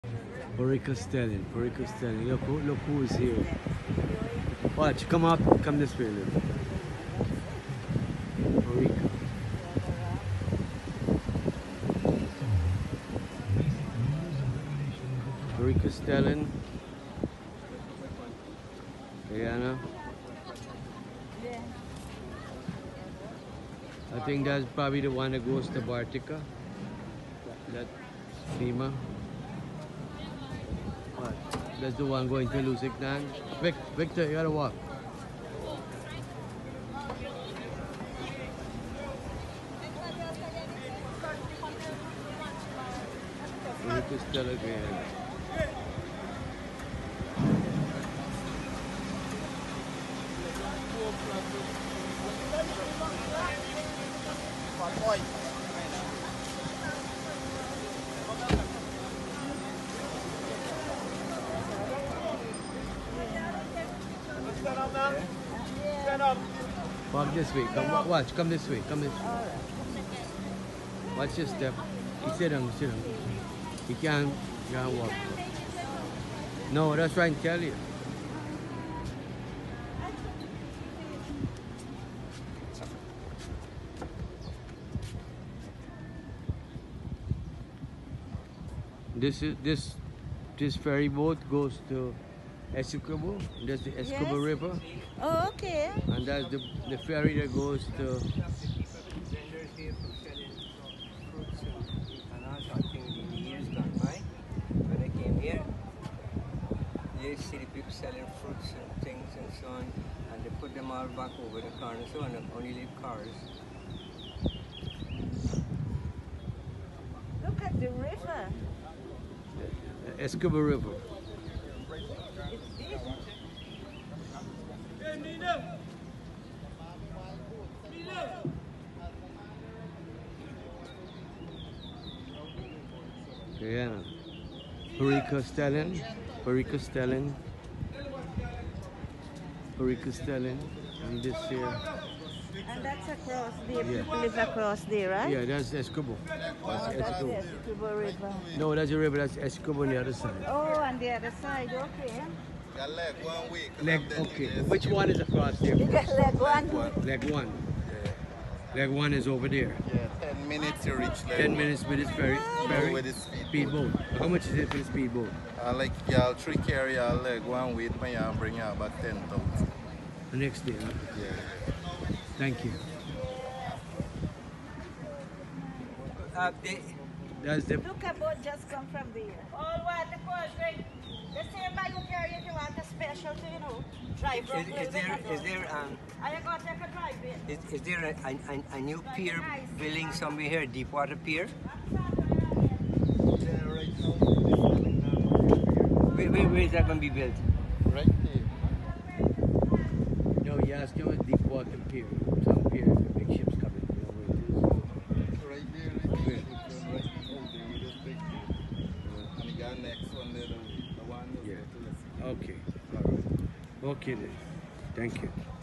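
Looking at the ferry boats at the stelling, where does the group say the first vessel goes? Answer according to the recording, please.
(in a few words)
Bartica.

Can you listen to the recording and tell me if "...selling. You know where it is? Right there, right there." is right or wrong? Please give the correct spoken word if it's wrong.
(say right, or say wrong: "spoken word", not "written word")
wrong: "coming", not "selling".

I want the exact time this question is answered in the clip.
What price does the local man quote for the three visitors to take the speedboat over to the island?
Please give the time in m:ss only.
2:49.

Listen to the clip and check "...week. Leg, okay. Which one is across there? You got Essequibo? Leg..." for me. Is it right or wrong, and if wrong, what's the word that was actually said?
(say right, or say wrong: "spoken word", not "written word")
wrong: "Leguan", not "Essequibo".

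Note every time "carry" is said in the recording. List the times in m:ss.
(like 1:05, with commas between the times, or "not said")
2:46, 3:02.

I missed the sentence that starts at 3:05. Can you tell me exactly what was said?
a Is, there a, a, new pier building somewhere here, Deepwater Pier?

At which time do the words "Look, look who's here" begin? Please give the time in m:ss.
0:02.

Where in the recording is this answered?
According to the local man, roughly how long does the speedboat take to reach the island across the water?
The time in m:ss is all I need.
2:41.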